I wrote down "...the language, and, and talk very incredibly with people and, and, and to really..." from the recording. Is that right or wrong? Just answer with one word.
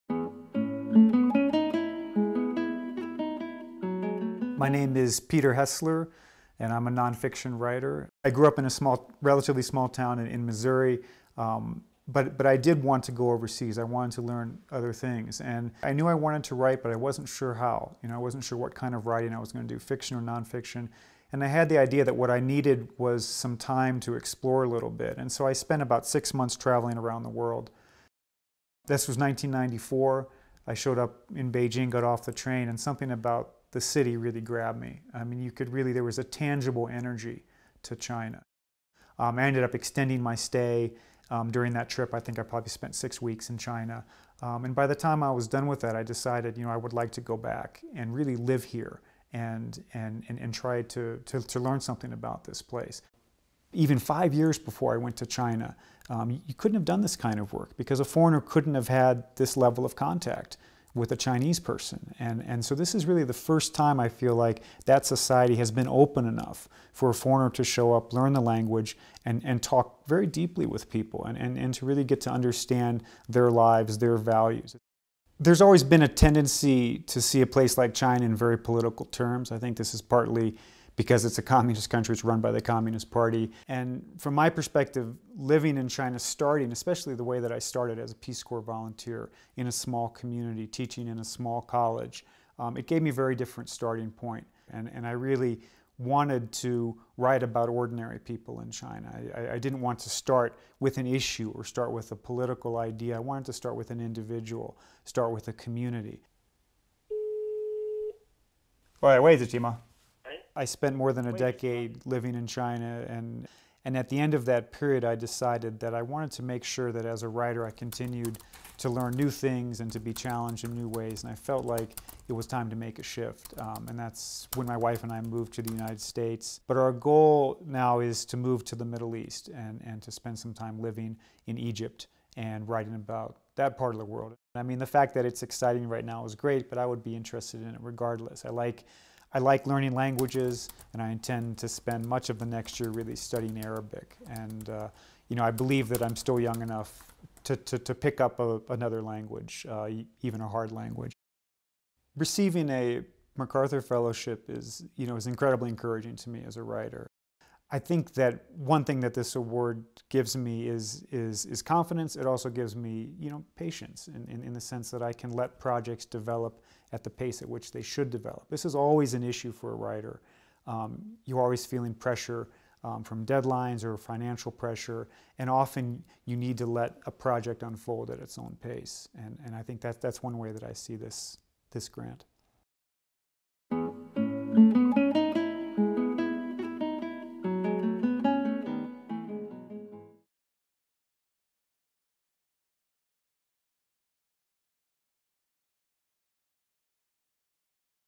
wrong.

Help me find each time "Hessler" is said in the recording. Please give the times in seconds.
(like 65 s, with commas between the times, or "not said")
5 s.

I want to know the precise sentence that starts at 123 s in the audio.
Um, and that's when my wife and I moved to the United States.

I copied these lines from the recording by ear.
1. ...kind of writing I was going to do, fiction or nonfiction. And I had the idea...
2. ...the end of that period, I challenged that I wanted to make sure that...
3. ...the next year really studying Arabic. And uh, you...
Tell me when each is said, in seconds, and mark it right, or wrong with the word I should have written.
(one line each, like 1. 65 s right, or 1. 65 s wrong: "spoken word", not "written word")
1. 18 s right
2. 114 s wrong: "decided", not "challenged"
3. 142 s right.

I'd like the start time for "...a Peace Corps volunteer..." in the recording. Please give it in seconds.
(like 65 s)
88 s.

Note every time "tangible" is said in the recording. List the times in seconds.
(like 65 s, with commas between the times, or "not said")
36 s.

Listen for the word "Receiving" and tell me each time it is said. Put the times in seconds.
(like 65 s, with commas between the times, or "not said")
152 s.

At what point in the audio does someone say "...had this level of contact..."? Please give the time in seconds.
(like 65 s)
58 s.